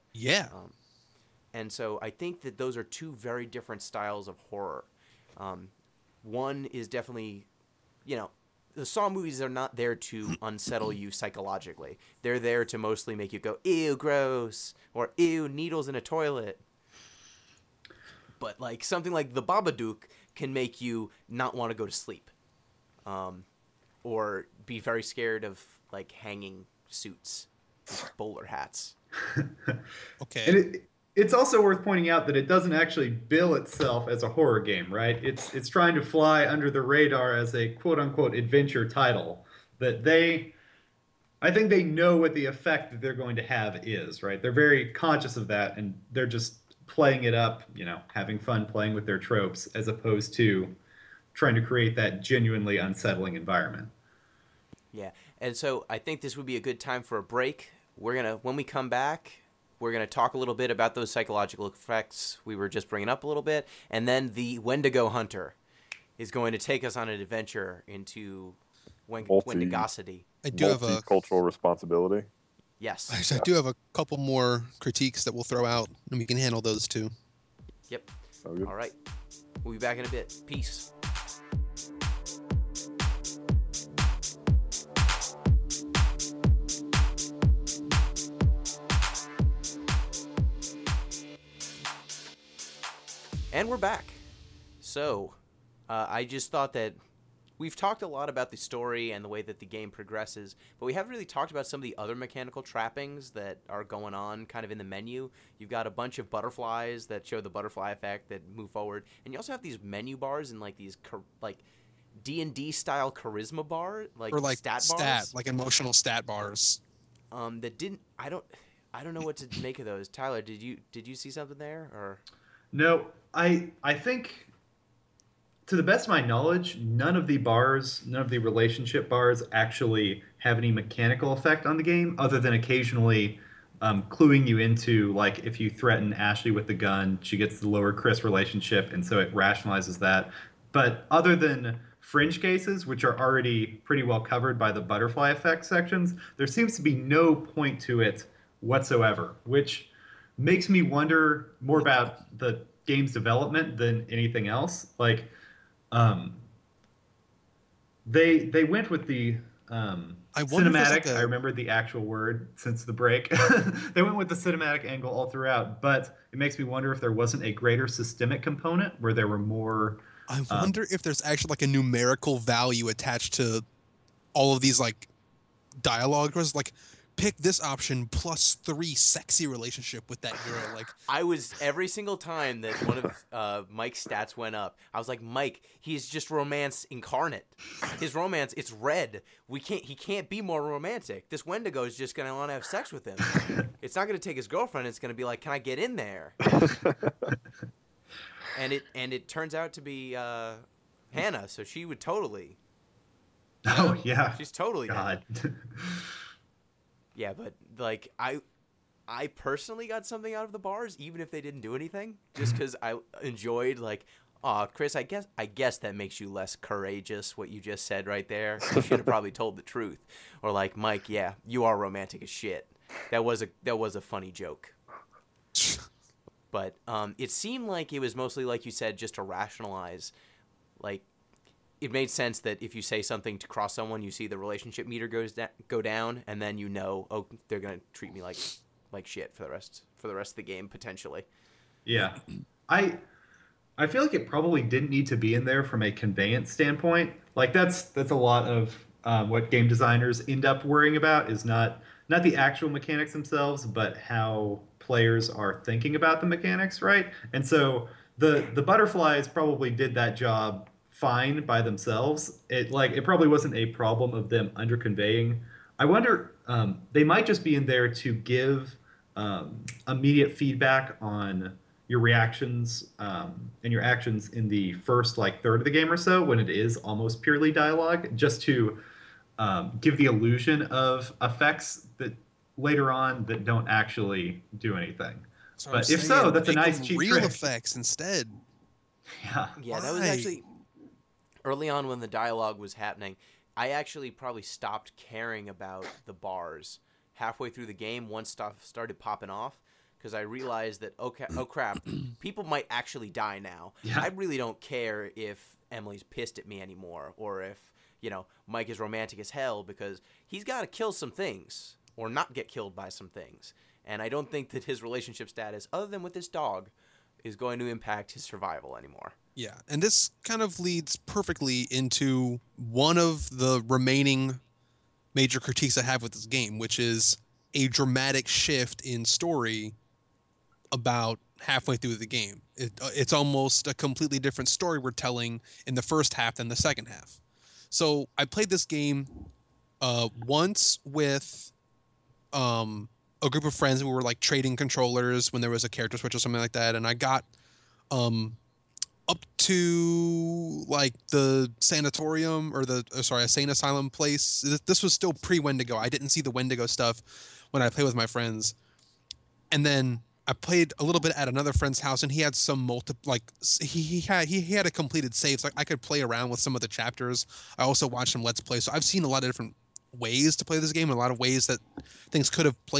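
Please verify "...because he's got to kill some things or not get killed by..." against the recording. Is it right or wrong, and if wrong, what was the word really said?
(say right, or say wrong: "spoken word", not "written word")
right.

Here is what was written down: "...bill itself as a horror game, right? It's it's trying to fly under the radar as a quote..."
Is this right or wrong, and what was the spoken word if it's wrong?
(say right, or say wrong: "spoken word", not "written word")
right.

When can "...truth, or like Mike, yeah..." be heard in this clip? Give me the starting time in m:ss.
3:39.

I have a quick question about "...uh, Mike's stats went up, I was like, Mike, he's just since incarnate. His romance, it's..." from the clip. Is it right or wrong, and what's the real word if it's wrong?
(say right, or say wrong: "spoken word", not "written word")
wrong: "romance", not "since".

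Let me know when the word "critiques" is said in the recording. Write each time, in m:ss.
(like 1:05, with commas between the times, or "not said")
1:14, 5:25.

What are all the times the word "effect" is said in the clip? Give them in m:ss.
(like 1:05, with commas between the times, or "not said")
0:42, 1:01, 1:47, 2:11, 2:25, 4:41, 4:47.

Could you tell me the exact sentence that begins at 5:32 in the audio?
It, uh, it's almost a completely different story we're telling in the first half than the second half.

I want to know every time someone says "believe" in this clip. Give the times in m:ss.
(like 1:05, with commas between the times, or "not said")
not said.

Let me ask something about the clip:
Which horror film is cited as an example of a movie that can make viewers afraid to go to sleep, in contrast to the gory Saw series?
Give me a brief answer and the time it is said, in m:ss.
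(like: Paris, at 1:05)
The Babadook, at 0:19.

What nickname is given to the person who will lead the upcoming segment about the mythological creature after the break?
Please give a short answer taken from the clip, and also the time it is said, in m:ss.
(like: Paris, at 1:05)
the Wendigo Hunter, at 1:04.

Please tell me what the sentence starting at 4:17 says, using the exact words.
And so the the butterflies probably did that job fine by themselves.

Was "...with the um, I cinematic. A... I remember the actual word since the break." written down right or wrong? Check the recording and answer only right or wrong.
right.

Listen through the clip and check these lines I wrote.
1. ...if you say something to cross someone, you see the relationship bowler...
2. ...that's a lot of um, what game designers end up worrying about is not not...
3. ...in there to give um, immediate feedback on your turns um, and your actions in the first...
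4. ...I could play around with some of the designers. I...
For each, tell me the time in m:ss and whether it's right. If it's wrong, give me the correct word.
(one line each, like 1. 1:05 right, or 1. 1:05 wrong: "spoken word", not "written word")
1. 3:52 wrong: "meter", not "bowler"
2. 4:07 right
3. 4:27 wrong: "reactions", not "turns"
4. 6:05 wrong: "chapters", not "designers".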